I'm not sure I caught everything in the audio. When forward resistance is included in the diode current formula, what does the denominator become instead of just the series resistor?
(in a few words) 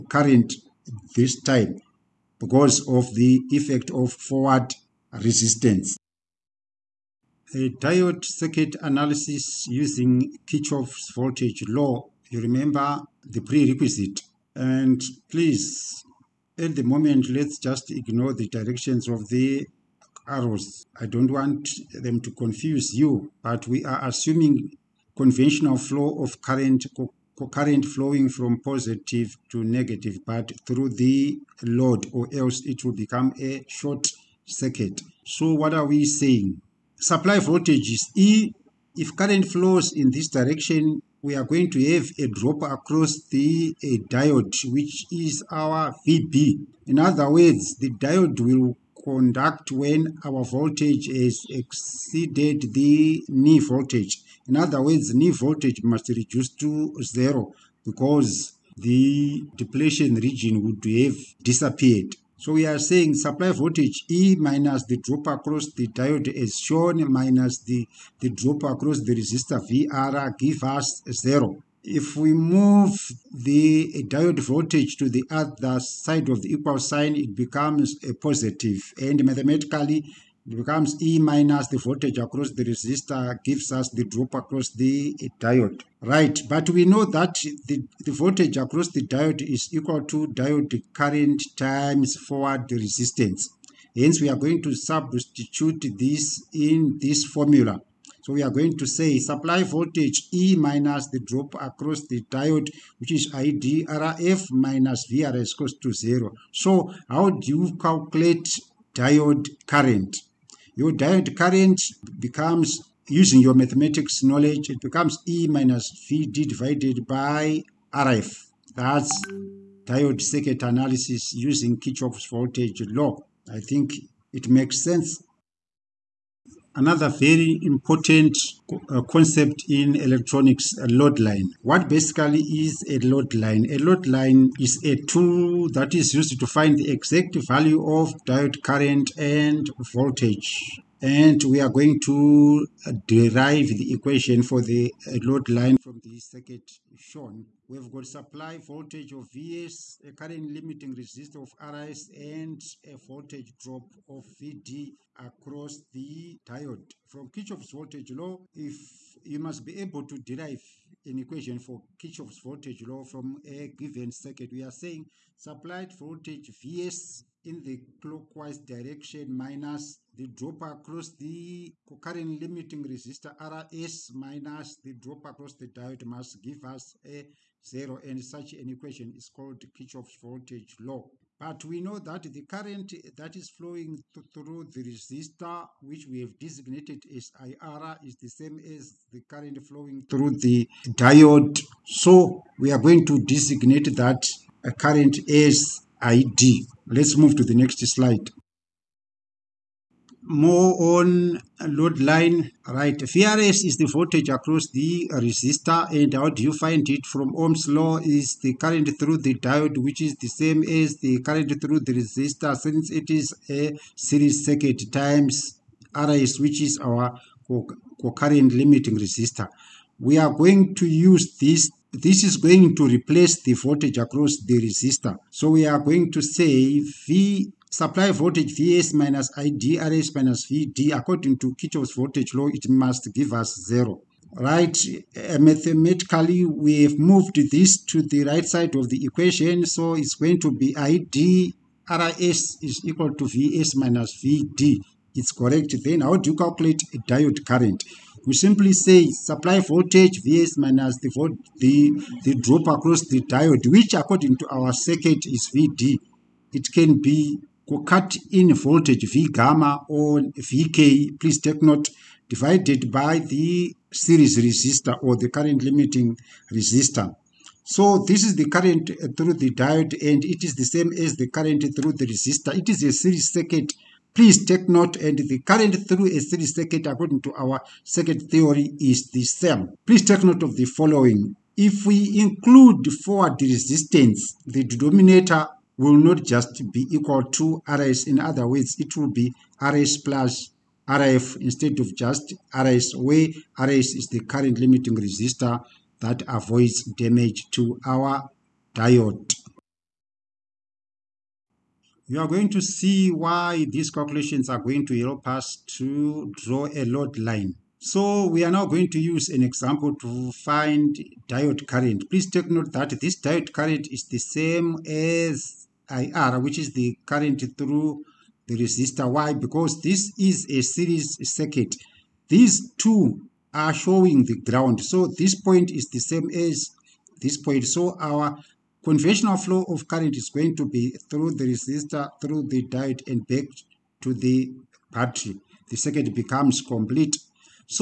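RS plus RF.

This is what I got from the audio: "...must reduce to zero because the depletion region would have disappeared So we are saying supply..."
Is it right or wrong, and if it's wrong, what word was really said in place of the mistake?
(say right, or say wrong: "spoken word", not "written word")
right.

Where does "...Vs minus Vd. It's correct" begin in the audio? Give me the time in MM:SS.
04:03.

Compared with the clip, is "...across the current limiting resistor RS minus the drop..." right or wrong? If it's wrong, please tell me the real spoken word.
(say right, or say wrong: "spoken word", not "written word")
right.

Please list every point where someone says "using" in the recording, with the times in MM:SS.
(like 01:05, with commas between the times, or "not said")
00:09, 01:53, 02:01.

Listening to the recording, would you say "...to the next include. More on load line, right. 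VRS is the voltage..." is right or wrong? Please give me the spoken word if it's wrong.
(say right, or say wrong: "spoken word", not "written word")
wrong: "slide", not "include".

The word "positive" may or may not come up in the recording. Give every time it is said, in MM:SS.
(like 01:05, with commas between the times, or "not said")
00:28, 01:18.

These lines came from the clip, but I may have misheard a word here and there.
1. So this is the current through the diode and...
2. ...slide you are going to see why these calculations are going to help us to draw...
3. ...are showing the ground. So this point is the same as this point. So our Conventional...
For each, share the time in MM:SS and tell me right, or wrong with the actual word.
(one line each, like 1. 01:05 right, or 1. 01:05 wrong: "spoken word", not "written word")
1. 04:27 right
2. 04:58 wrong: "diode", not "slide"
3. 05:23 right.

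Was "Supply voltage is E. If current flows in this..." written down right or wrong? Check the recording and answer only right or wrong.
right.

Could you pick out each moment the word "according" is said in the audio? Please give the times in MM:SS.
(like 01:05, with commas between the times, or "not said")
03:50, 04:13, 04:36.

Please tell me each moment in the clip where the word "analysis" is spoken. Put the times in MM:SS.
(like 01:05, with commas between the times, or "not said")
00:08, 02:00.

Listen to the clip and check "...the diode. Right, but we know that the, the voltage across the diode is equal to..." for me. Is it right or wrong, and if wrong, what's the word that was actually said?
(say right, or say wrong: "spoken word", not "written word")
right.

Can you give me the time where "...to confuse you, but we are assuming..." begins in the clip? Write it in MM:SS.
00:22.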